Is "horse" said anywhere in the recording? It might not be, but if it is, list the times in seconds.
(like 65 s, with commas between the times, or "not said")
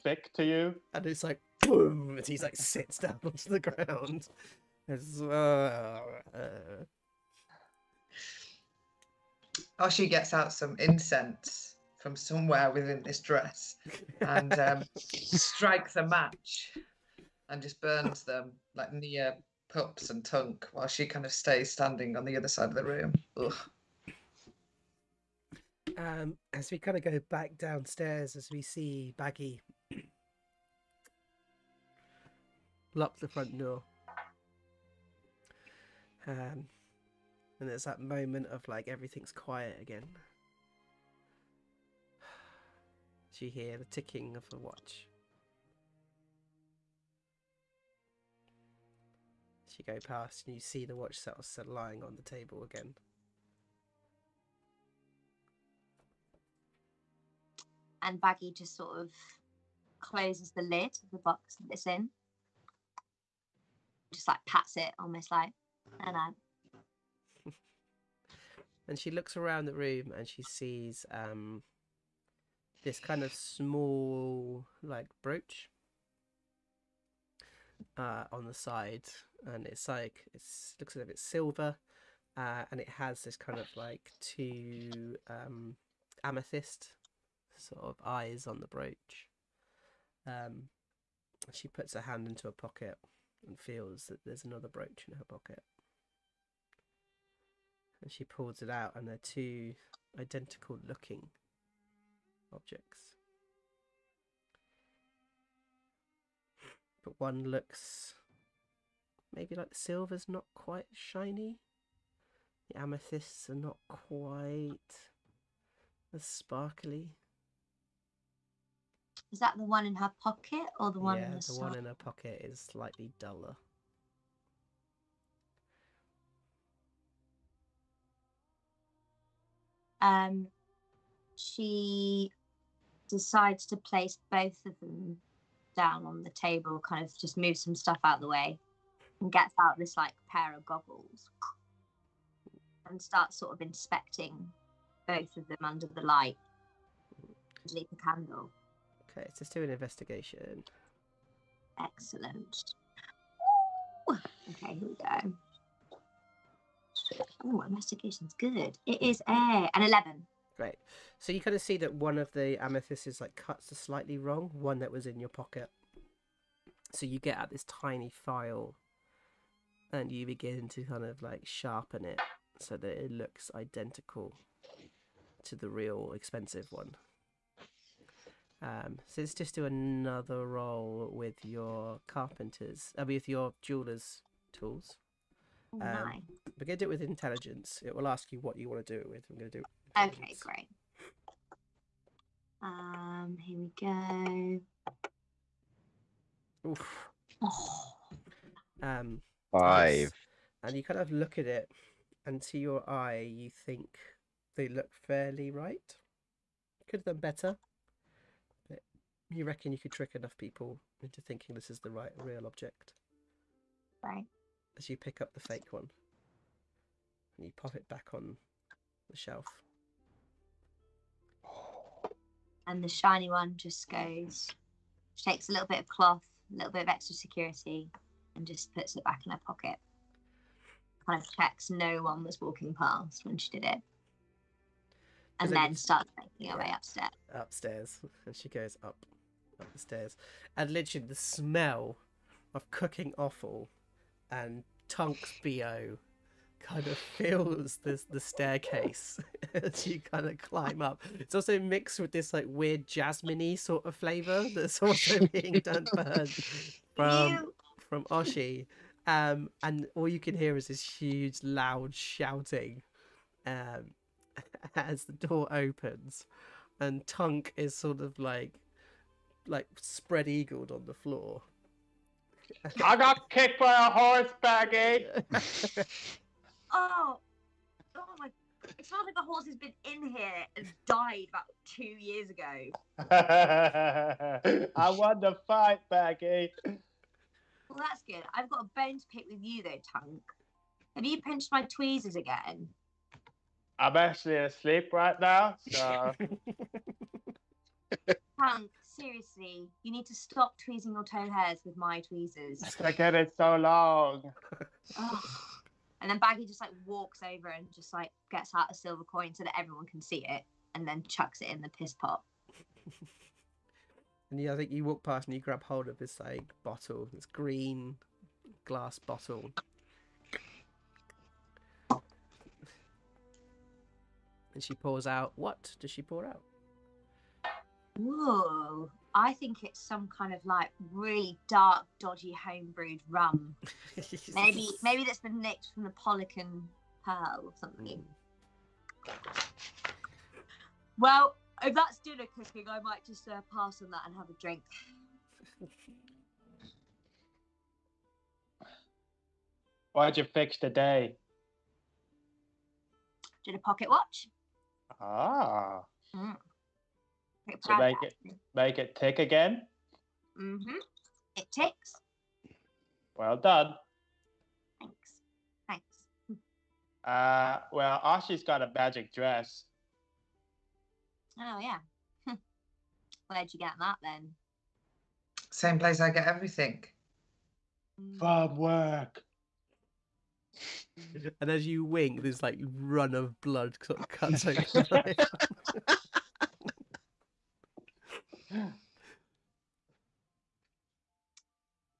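273 s, 279 s.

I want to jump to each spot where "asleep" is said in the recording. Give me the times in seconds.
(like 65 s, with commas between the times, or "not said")
294 s.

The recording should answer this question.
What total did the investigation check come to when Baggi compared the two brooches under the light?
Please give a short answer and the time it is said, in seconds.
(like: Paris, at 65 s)
11, at 159 s.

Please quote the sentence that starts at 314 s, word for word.
and yeah, I think you walk past and you grab hold of this like bottle, this green glass bottle.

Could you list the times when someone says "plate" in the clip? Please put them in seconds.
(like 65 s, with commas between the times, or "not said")
not said.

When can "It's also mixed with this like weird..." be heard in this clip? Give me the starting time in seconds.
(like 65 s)
251 s.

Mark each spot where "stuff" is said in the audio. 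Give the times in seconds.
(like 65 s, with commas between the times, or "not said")
137 s.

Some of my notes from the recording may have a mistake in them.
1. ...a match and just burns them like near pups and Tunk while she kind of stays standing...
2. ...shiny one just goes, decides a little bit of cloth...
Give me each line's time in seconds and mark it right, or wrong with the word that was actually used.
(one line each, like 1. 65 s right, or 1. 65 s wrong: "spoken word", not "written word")
1. 15 s right
2. 222 s wrong: "takes", not "decides".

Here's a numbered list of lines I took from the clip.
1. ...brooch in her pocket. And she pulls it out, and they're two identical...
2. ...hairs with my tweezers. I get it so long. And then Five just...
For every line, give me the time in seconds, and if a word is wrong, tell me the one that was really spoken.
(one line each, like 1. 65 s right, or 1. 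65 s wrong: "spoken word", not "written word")
1. 94 s right
2. 301 s wrong: "Baggy", not "Five".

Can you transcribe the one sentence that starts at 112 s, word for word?
The amethysts are not quite as sparkly.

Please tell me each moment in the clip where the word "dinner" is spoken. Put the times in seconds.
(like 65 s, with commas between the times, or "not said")
341 s.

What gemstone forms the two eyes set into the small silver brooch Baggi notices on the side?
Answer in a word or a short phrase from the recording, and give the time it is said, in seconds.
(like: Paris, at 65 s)
Amethyst, at 86 s.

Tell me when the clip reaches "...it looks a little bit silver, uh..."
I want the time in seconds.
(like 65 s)
80 s.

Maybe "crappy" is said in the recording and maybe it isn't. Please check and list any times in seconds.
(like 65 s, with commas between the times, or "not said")
not said.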